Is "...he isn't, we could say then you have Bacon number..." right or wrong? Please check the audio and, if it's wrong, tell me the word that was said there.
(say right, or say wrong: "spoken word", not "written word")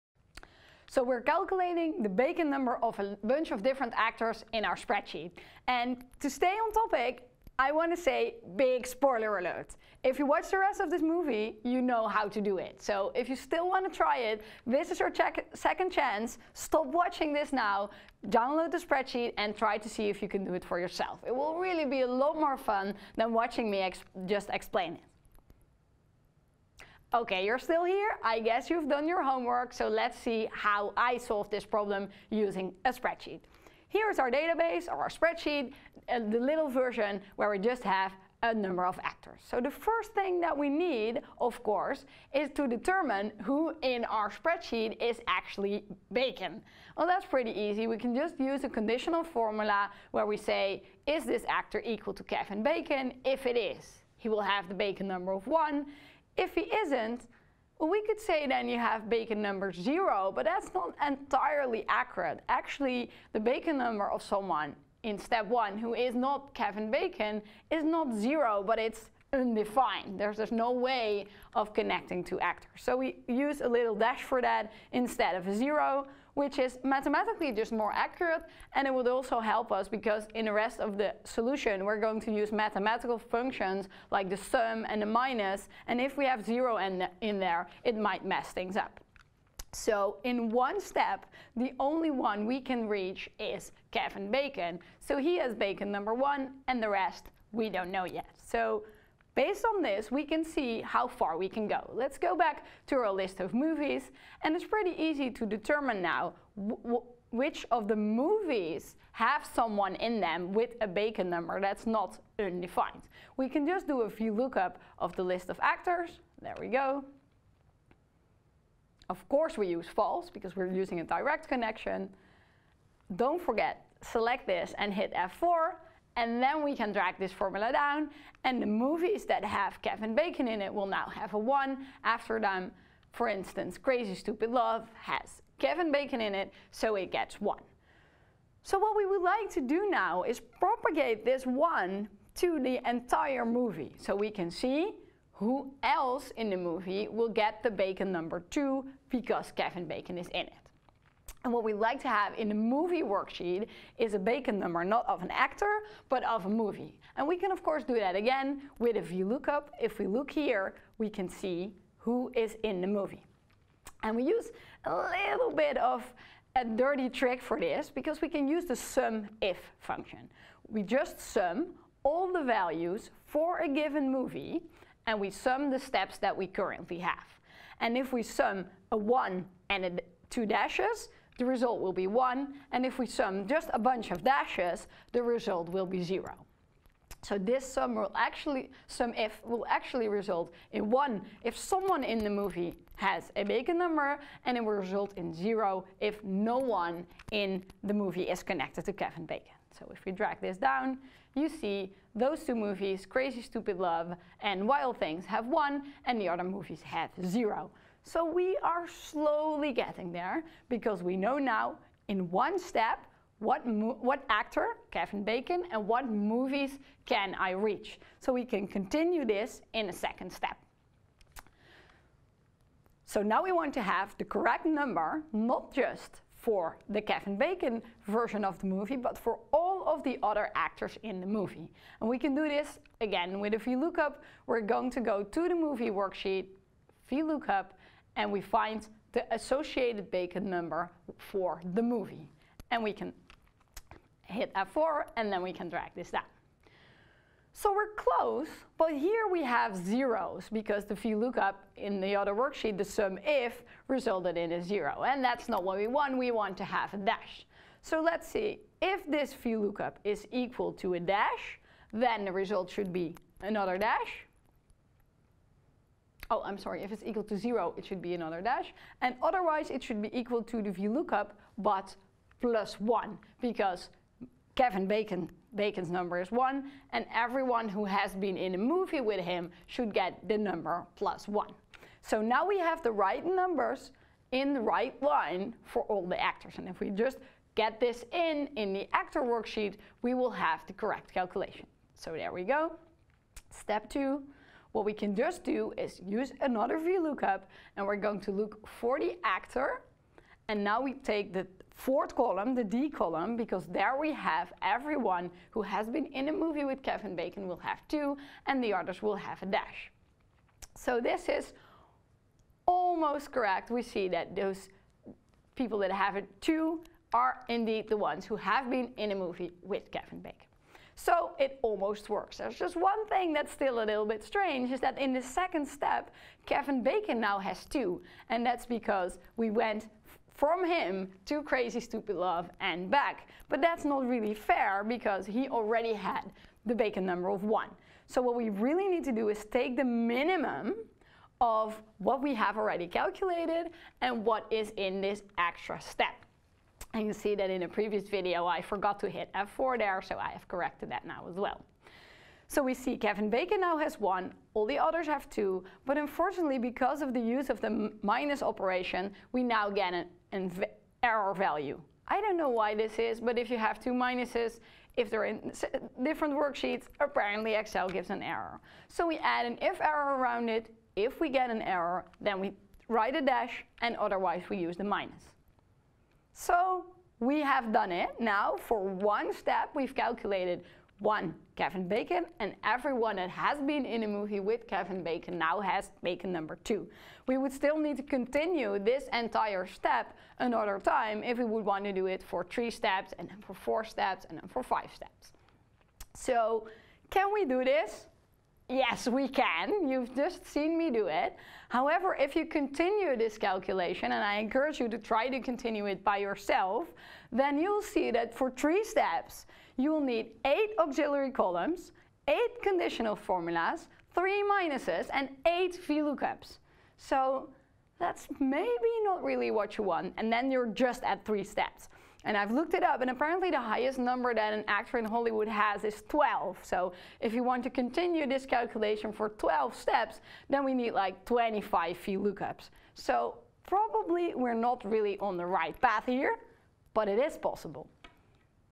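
right.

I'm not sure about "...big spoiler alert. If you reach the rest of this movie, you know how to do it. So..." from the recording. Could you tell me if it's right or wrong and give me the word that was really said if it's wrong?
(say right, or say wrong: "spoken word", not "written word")
wrong: "watch", not "reach".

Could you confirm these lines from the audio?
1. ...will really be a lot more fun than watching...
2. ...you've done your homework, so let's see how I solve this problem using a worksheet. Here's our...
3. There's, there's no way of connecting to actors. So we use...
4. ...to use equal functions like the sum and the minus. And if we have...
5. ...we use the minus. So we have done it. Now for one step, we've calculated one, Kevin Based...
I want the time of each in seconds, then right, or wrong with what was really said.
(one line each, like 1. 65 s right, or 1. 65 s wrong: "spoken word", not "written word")
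1. 21 s right
2. 28 s wrong: "spreadsheet", not "worksheet"
3. 70 s right
4. 82 s wrong: "mathematical", not "equal"
5. 374 s wrong: "Bacon", not "Based".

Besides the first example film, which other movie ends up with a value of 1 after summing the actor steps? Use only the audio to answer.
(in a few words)
Wild Things.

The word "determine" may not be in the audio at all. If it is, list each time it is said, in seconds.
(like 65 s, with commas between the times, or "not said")
42 s, 105 s.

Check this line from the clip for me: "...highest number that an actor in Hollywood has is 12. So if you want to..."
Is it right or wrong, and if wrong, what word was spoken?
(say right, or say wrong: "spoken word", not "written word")
right.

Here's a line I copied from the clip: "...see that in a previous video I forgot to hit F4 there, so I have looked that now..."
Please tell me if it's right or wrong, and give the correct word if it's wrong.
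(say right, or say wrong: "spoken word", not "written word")
wrong: "corrected", not "looked".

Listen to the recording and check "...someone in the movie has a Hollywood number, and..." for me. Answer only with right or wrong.
wrong.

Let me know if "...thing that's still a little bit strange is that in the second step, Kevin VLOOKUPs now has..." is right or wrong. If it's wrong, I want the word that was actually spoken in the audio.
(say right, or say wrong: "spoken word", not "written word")
wrong: "Bacon", not "VLOOKUPs".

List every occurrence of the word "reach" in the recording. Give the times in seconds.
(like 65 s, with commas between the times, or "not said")
92 s, 217 s.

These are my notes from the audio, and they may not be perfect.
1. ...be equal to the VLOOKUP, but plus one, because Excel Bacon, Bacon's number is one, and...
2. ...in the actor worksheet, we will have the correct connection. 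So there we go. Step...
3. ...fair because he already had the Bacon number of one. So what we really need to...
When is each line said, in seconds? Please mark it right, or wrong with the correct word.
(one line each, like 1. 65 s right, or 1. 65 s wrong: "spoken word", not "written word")
1. 270 s wrong: "Kevin", not "Excel"
2. 288 s wrong: "calculation", not "connection"
3. 334 s right.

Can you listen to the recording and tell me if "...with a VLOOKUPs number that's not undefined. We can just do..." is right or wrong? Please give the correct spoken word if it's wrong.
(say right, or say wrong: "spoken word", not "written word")
wrong: "Bacon", not "VLOOKUPs".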